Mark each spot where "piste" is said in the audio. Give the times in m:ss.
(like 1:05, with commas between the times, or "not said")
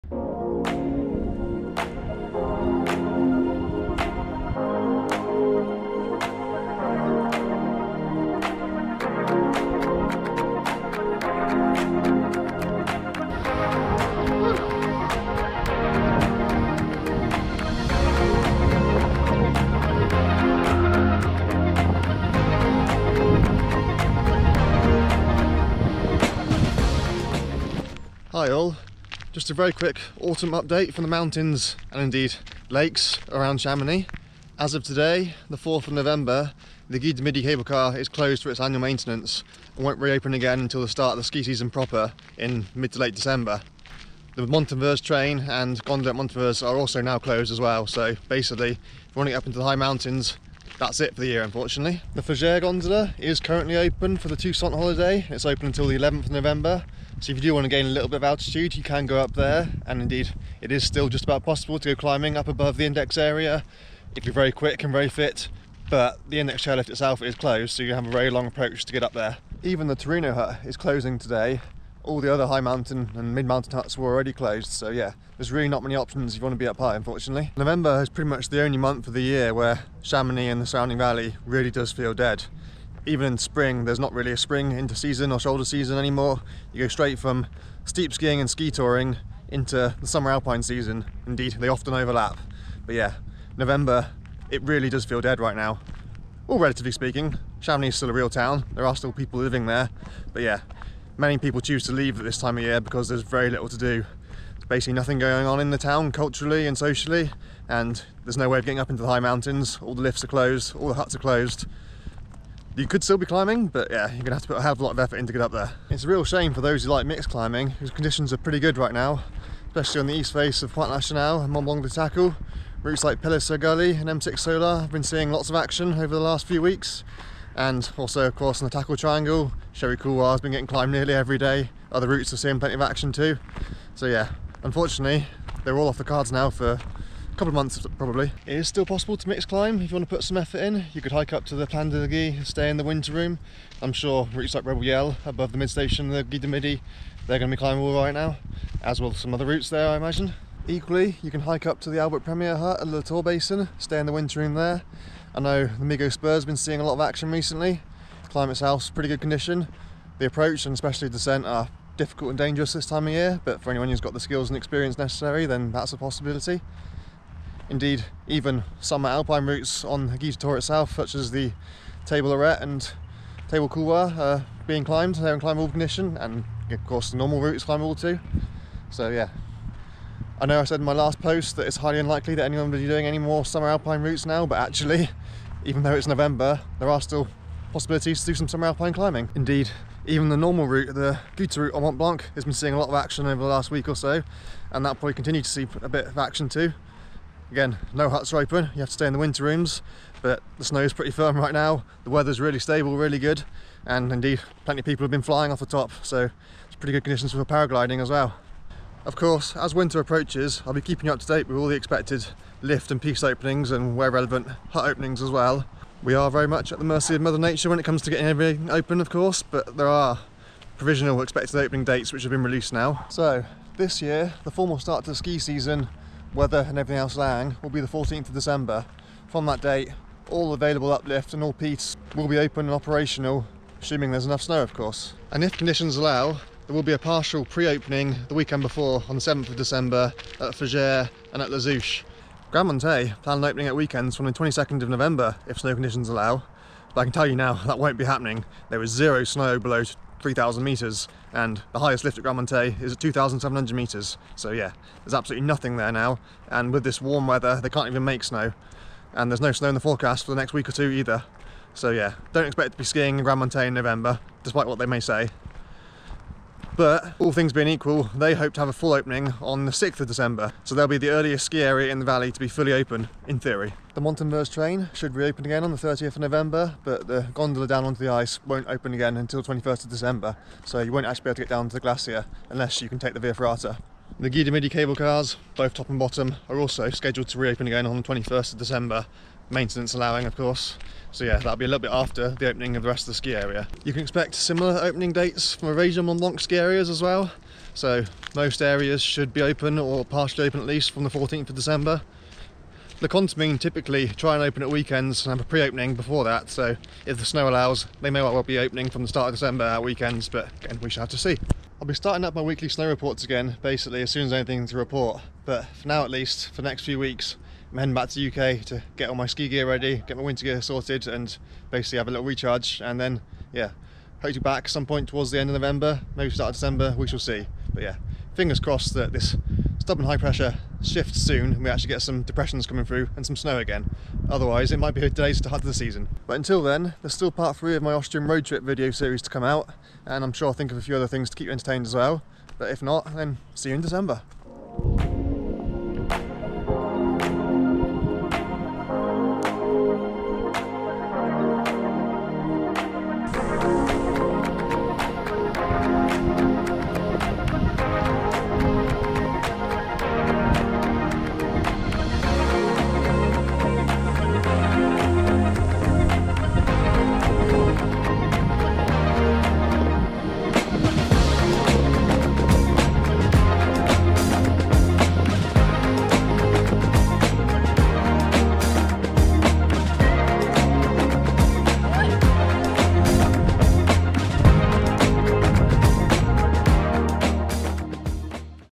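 3:33, 3:51.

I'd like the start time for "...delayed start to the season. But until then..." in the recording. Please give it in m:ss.
5:35.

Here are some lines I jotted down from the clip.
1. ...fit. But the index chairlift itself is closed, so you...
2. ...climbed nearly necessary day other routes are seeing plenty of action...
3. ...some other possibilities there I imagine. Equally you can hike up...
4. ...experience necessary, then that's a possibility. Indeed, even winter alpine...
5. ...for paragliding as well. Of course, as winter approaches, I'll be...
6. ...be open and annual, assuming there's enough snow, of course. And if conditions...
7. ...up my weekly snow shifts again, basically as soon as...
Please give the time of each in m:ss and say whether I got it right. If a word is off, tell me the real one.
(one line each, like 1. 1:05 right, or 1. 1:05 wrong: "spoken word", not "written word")
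1. 1:05 right
2. 2:10 wrong: "every", not "necessary"
3. 2:29 wrong: "routes", not "possibilities"
4. 2:44 wrong: "summer", not "winter"
5. 3:27 right
6. 3:52 wrong: "operational", not "annual"
7. 5:12 wrong: "reports", not "shifts".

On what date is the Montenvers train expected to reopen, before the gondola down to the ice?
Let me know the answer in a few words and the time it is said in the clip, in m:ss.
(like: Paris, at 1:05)
30th of November, at 4:35.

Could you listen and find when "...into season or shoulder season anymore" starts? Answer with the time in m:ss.
1:24.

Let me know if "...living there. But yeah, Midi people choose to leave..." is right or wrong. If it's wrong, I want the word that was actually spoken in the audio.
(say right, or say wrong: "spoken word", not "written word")
wrong: "Many", not "Midi".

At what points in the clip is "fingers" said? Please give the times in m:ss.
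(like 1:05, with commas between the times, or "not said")
5:28.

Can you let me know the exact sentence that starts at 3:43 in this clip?
So, this year, the formal start to the ski season, weather and everything else lang, will be the 14th of December.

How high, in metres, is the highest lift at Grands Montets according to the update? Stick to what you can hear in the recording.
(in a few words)
2,700 metres.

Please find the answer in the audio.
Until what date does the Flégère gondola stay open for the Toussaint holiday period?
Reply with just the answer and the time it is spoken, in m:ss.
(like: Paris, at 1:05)
11th of November, at 0:55.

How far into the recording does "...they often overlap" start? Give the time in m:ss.
1:31.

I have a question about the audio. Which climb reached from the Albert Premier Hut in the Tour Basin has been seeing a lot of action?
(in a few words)
Migot Spur.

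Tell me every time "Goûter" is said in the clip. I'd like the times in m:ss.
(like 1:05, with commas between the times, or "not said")
3:11.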